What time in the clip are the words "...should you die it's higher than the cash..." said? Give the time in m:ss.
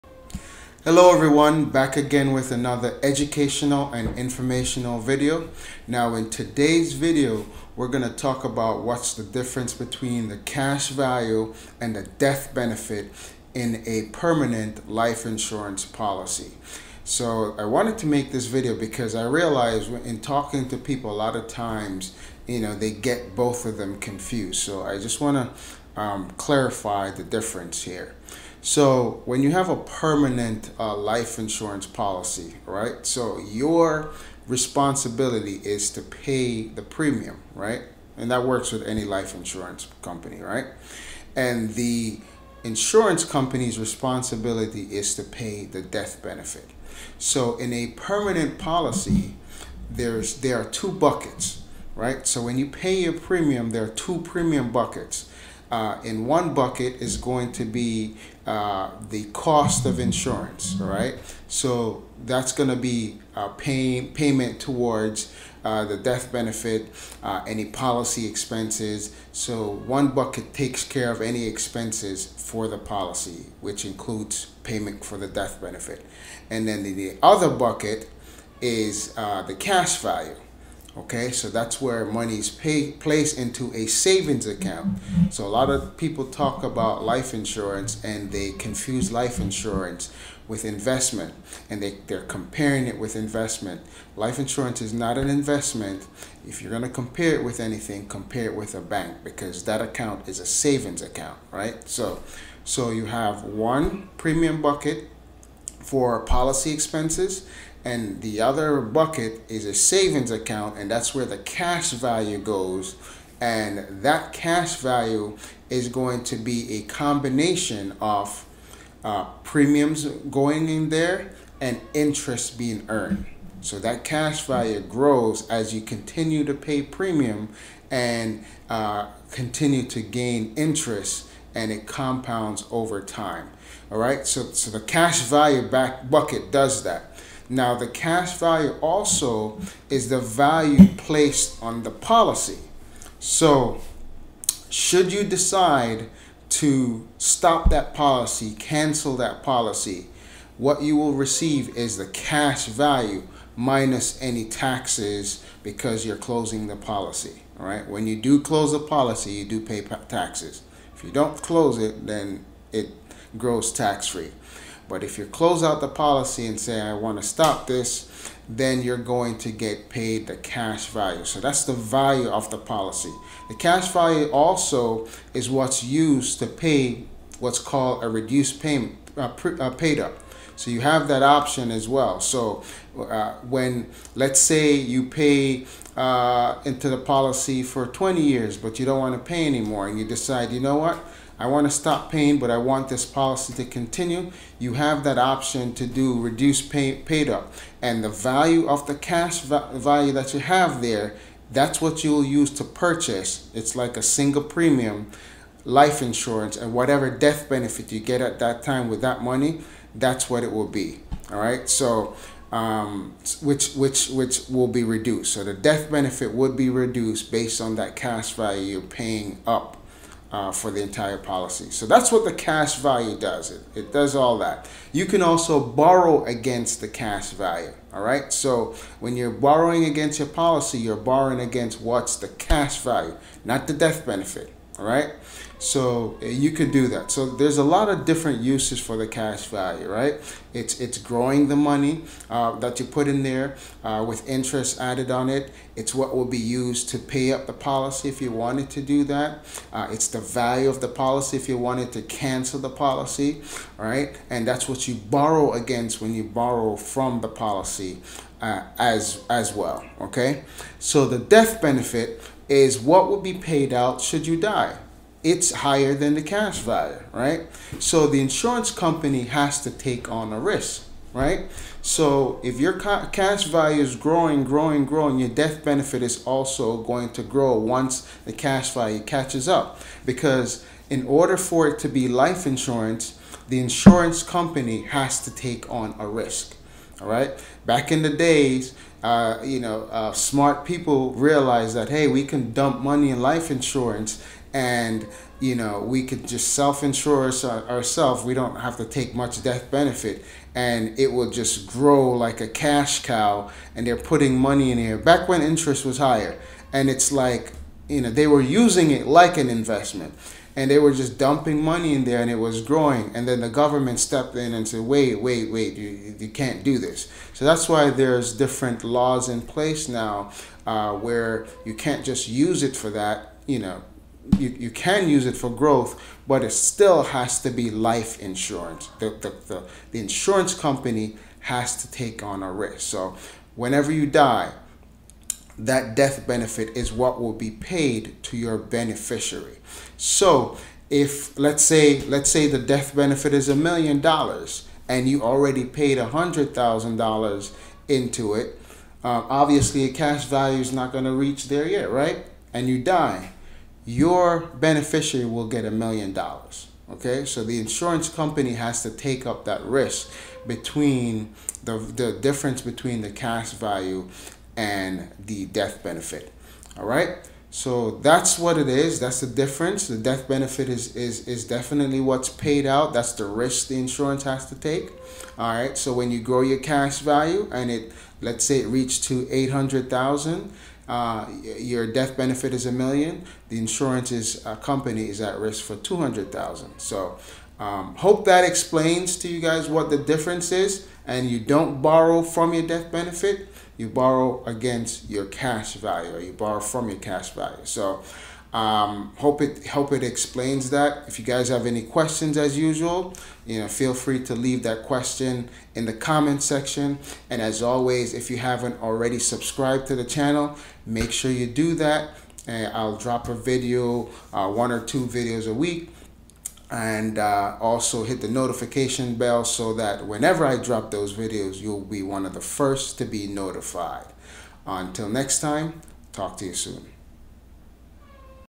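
4:24.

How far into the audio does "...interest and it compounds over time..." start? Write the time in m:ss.
2:10.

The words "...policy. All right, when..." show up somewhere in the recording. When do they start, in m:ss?
2:36.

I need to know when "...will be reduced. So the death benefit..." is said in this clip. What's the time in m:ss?
3:34.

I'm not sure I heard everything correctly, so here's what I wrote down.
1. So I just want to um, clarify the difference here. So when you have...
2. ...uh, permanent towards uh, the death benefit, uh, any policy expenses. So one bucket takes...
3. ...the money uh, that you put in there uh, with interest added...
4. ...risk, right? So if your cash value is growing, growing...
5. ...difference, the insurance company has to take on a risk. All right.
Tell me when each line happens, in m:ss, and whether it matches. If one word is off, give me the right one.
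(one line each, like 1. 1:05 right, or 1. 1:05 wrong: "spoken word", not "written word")
1. 0:24 right
2. 1:03 wrong: "payment", not "permanent"
3. 4:01 right
4. 4:30 right
5. 4:42 wrong: "insurance", not "difference".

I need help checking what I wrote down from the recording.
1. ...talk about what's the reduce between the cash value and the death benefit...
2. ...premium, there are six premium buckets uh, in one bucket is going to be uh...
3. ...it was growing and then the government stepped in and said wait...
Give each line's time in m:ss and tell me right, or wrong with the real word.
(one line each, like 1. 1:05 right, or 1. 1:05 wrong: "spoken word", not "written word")
1. 0:08 wrong: "difference", not "reduce"
2. 0:53 wrong: "two", not "six"
3. 5:12 right.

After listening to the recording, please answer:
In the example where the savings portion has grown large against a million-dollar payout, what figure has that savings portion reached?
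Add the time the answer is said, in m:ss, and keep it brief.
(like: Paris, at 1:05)
800,000, at 6:19.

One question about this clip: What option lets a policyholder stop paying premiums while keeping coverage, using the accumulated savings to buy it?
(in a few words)
reduced payment, paid up.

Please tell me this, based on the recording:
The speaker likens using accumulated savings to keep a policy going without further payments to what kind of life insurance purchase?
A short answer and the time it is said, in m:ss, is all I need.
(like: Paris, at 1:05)
single premium life insurance, at 3:24.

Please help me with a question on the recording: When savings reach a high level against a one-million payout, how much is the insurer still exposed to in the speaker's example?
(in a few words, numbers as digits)
200,000.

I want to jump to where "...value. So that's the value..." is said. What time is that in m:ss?
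2:50.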